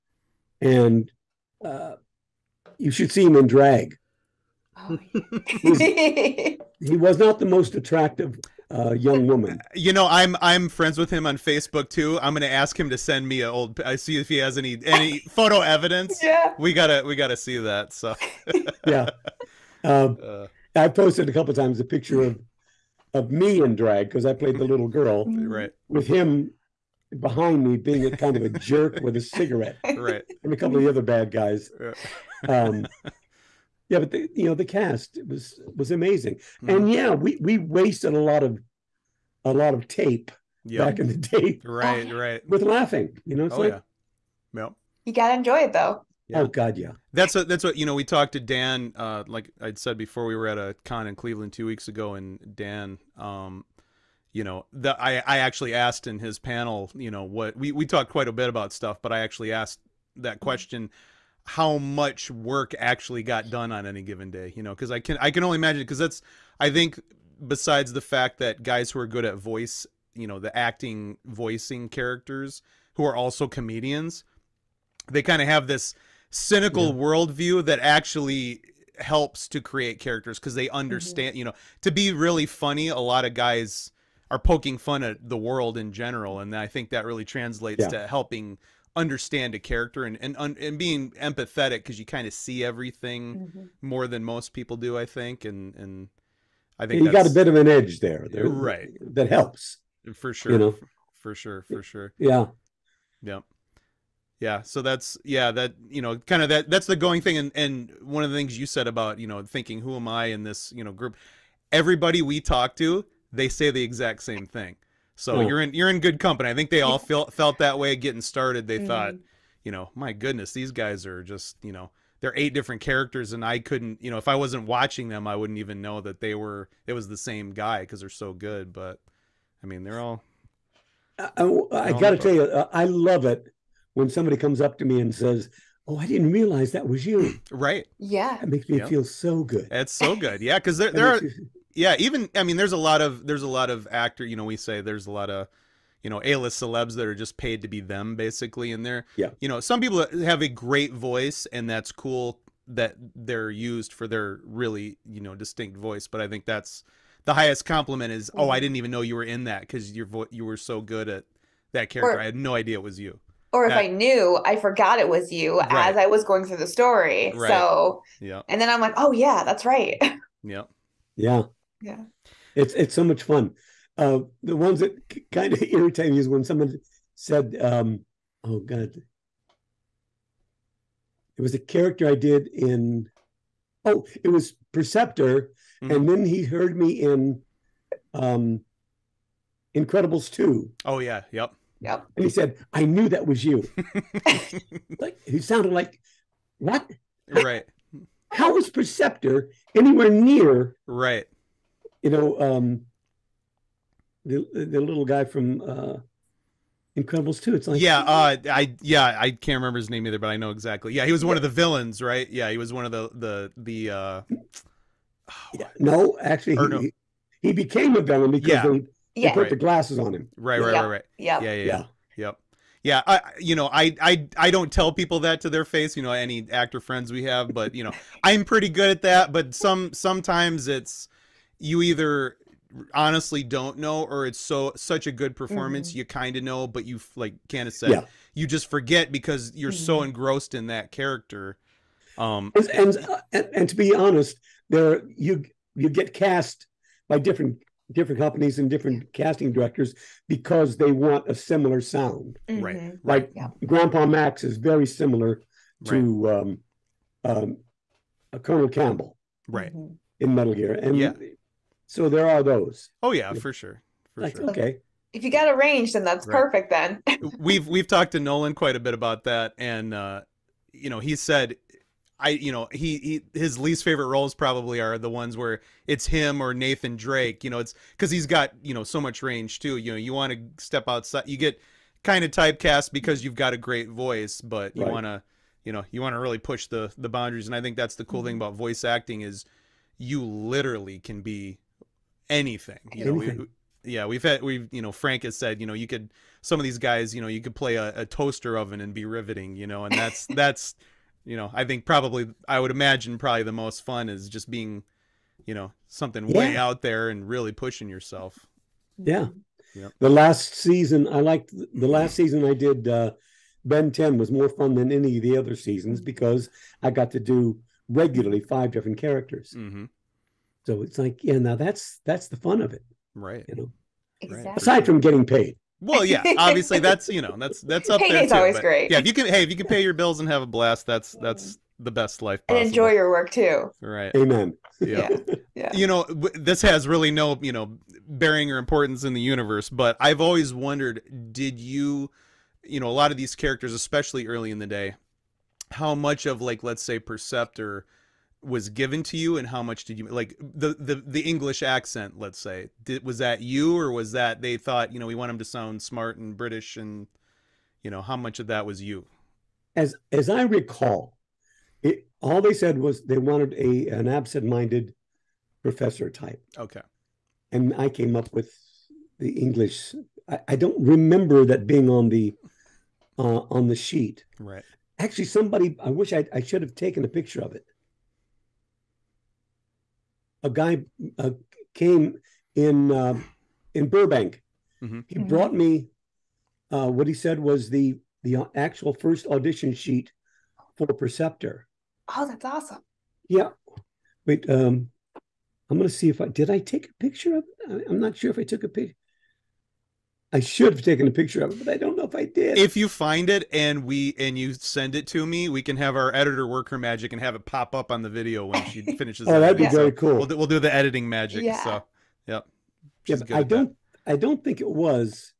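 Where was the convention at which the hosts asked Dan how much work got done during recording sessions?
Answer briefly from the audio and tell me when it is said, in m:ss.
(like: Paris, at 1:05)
Cleveland, at 0:51.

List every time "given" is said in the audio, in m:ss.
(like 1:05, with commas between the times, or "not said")
1:04, 5:48.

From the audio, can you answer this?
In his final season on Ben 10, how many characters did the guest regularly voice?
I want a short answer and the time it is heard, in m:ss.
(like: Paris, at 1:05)
5, at 5:18.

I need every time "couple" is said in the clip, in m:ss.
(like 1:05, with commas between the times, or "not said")
0:21, 0:30.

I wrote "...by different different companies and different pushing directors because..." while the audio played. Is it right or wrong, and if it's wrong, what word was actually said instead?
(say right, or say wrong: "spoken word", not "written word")
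wrong: "casting", not "pushing".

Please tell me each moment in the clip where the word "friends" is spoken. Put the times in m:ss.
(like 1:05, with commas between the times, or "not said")
0:10, 3:46.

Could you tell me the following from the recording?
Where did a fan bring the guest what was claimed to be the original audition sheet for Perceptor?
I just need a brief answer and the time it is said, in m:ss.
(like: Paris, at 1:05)
Burbank, at 6:23.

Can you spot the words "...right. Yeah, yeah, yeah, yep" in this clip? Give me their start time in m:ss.
3:40.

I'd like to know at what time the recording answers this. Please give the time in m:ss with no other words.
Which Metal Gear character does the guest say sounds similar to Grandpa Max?
4:18.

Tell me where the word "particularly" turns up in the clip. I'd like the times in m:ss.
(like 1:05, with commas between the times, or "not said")
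not said.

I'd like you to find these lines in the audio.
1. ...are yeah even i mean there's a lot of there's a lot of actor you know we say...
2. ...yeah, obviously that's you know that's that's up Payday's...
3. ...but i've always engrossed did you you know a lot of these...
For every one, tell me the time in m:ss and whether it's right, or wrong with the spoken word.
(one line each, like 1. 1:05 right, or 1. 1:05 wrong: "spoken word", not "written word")
1. 2:21 right
2. 5:26 right
3. 5:39 wrong: "wondered", not "engrossed".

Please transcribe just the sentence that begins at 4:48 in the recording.
about voice acting is you literally can be anything.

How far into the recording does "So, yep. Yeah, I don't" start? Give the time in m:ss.
6:51.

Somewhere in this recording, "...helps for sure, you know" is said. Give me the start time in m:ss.
1:39.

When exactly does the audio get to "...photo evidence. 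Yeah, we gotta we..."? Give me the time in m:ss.
0:15.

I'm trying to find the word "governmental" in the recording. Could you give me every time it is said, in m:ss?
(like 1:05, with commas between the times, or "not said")
not said.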